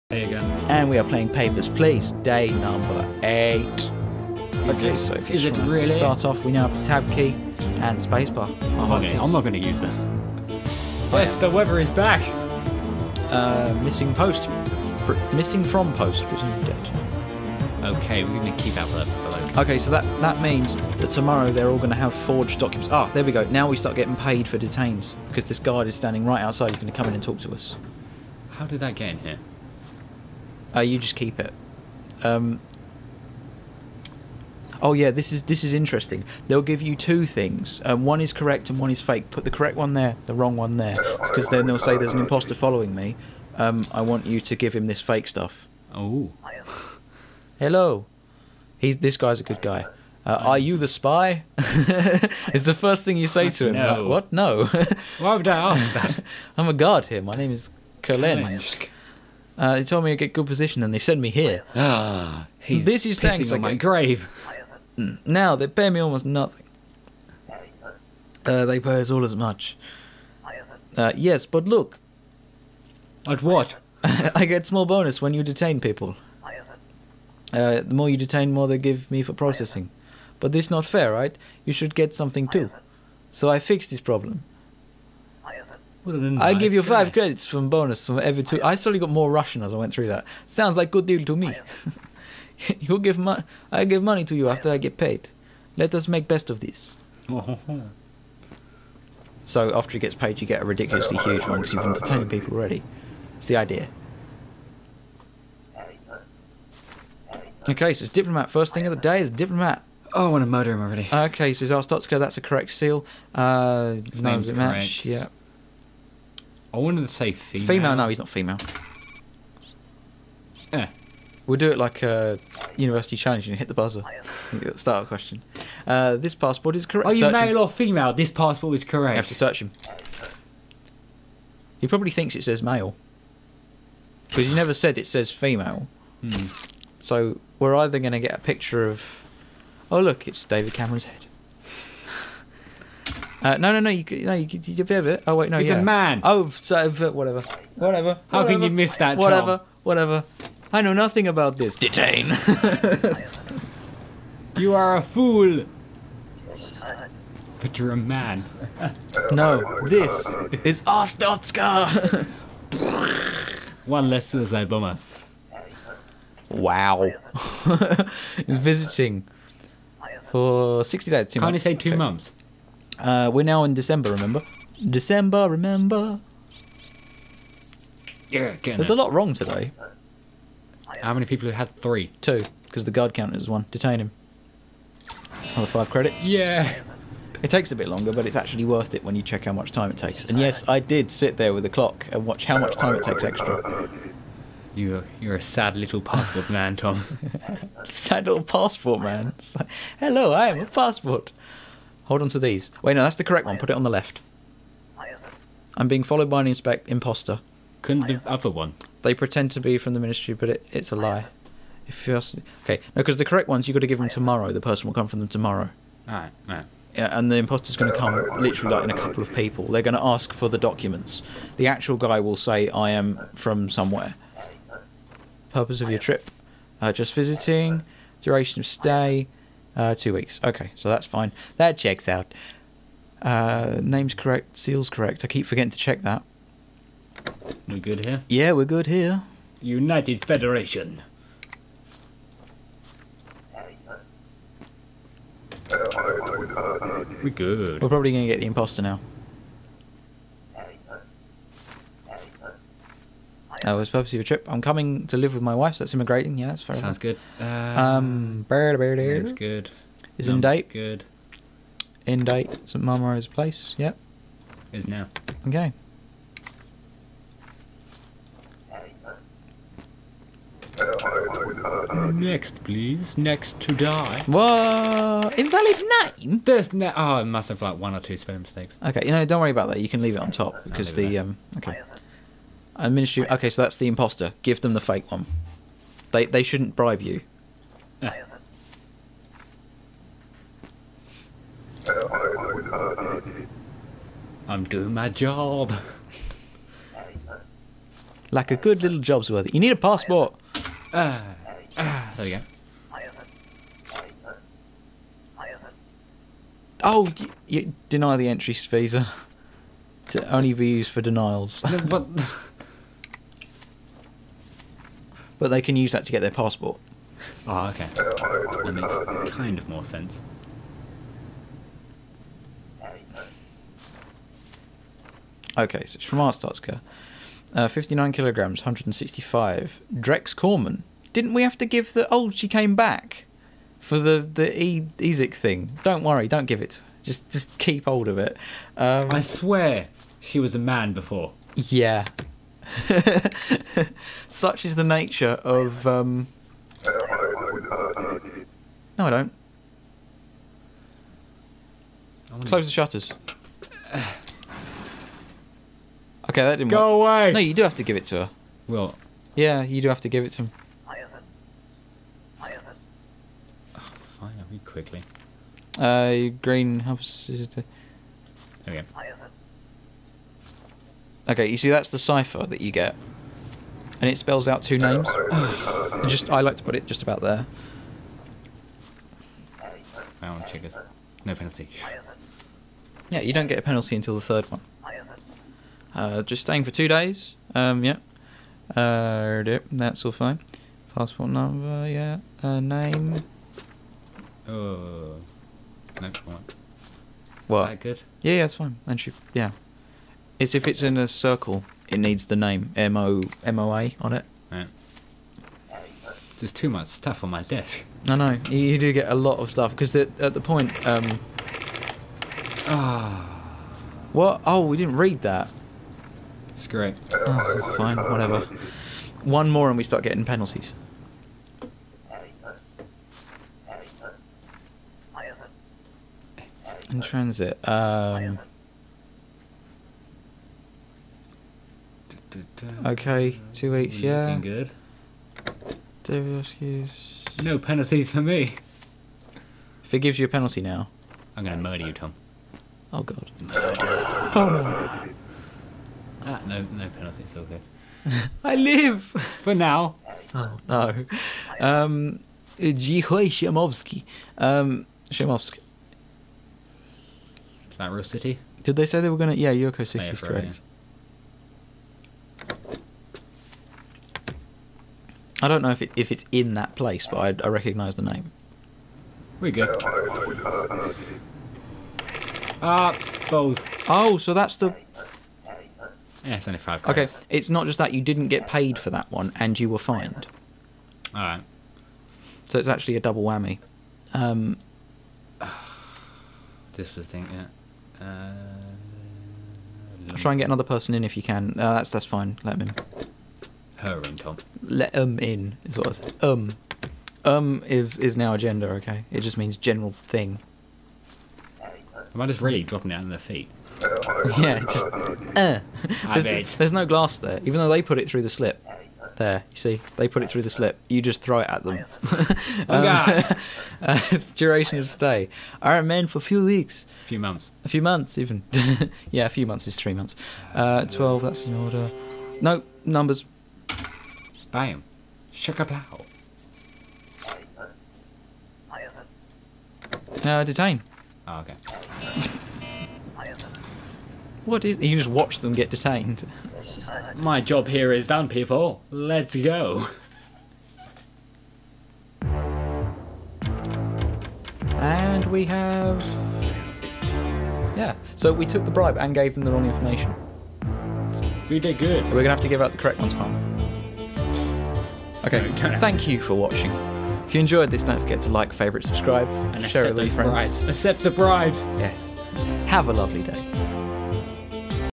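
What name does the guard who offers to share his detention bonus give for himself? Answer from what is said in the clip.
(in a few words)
Calensk.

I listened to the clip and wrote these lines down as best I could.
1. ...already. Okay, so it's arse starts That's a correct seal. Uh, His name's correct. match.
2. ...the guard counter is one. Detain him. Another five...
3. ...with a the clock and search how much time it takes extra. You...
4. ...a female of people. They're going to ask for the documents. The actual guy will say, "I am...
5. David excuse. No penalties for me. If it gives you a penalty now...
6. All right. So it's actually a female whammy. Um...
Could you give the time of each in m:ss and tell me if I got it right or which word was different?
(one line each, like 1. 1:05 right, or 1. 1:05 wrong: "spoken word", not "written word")
1. 1:50 right
2. 3:02 right
3. 3:11 wrong: "watch", not "search"
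4. 3:38 wrong: "couple", not "female"
5. 7:16 right
6. 8:01 wrong: "double", not "female".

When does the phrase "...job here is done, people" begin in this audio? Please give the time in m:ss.
8:57.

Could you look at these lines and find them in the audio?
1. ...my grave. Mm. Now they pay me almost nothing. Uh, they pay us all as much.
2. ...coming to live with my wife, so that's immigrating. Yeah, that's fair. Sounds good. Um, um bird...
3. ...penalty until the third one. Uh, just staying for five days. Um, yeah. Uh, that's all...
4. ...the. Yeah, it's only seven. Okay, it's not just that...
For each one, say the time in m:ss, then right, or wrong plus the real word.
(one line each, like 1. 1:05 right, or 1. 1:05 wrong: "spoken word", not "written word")
1. 1:03 right
2. 4:14 right
3. 6:23 wrong: "two", not "five"
4. 7:54 wrong: "five", not "seven".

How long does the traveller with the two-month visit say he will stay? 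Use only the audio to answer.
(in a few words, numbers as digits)
60.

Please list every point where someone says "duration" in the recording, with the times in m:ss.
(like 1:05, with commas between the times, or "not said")
3:48, 8:34.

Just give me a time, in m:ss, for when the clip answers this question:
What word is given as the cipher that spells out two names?
6:06.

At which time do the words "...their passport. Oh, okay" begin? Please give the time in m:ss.
5:16.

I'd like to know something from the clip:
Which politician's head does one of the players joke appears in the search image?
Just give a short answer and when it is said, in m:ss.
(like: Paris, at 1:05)
David Cameron, at 2:20.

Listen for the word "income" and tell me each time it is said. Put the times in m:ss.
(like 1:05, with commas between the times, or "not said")
8:14.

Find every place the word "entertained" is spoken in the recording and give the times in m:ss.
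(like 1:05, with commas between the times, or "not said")
1:41.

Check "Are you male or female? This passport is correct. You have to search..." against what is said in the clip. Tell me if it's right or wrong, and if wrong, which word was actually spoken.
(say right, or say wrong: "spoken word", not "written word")
right.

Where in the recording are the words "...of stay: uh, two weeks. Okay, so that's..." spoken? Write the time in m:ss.
3:48.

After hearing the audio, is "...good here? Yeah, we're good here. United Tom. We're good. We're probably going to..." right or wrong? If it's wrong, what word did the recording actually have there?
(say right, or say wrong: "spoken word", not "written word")
wrong: "Federation", not "Tom".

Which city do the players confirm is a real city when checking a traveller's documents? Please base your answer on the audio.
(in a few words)
Yurko City.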